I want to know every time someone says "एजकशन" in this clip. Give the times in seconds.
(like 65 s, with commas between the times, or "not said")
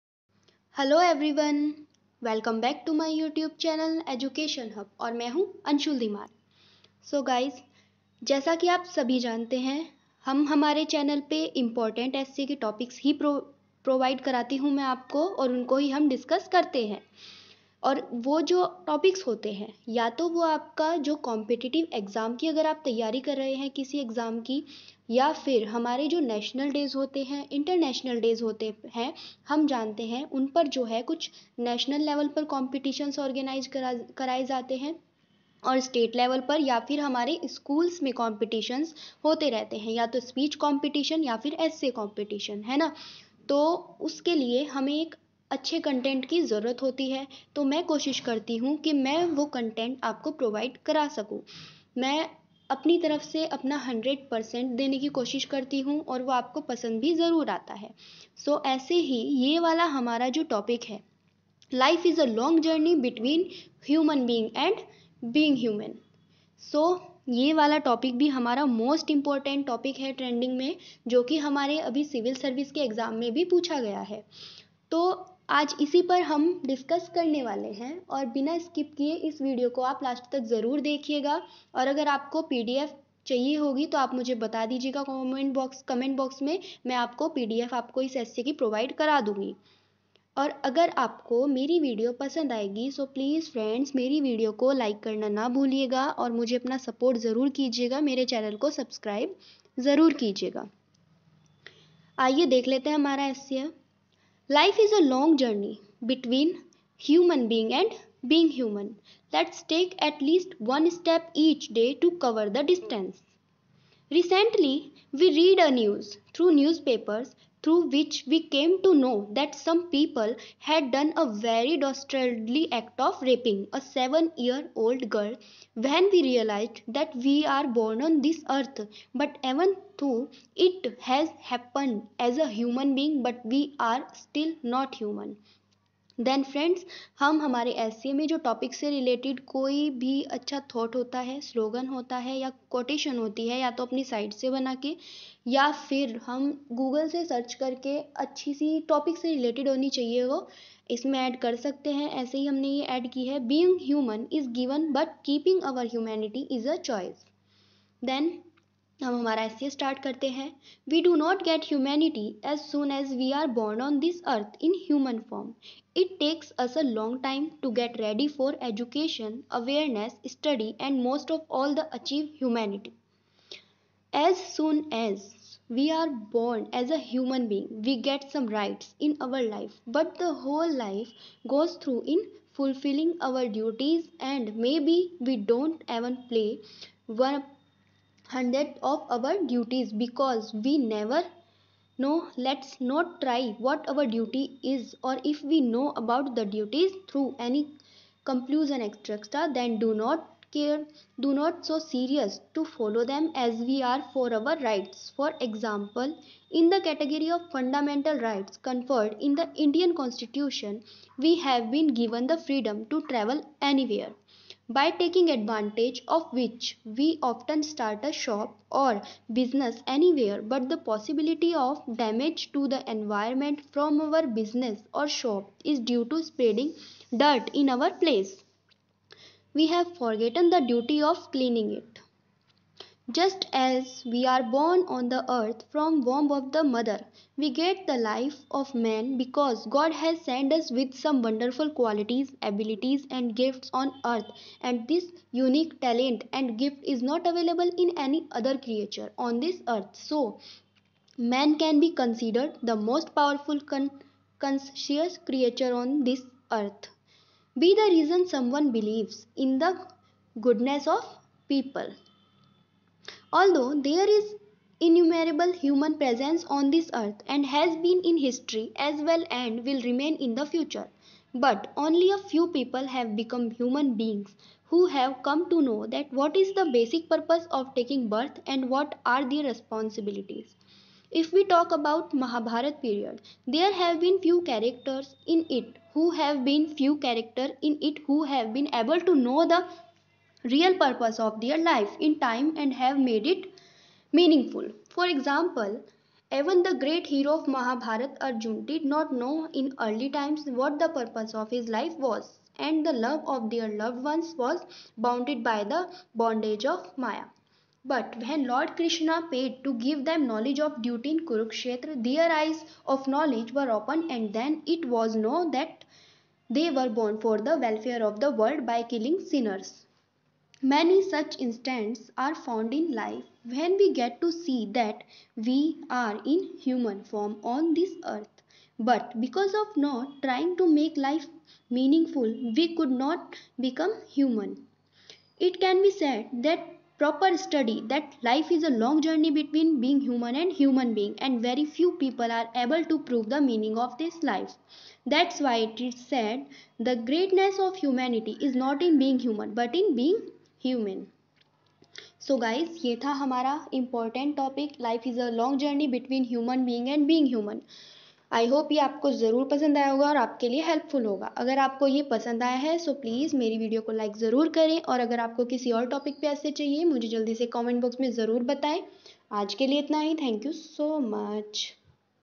4 s, 168 s.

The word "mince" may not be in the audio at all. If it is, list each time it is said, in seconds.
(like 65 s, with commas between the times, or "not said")
not said.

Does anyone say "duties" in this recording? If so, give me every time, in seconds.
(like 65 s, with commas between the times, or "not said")
189 s, 196 s.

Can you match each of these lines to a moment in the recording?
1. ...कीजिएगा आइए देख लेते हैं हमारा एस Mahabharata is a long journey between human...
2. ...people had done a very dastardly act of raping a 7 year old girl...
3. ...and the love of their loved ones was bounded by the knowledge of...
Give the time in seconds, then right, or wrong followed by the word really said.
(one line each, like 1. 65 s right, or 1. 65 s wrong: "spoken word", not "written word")
1. 100 s wrong: "Life", not "Mahabharata"
2. 119 s right
3. 302 s wrong: "bondage", not "knowledge".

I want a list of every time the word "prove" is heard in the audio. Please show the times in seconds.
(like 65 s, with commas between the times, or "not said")
342 s.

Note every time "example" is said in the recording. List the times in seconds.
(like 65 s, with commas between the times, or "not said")
205 s, 295 s.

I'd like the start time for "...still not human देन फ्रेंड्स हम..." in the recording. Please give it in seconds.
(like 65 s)
134 s.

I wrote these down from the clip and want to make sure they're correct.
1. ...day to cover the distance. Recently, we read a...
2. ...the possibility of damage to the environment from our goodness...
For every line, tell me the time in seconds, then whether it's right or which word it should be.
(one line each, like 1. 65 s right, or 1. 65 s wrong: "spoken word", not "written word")
1. 111 s right
2. 220 s wrong: "business", not "goodness".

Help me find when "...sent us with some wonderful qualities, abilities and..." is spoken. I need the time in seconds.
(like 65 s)
240 s.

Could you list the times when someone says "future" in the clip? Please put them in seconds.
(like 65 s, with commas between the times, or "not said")
270 s.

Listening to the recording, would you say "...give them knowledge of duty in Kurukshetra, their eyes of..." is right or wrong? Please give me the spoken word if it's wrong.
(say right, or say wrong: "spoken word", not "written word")
right.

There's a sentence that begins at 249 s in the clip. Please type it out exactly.
So, man can be considered the most powerful con- conscious creature on this earth.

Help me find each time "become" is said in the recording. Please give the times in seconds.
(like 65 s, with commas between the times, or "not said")
273 s, 333 s.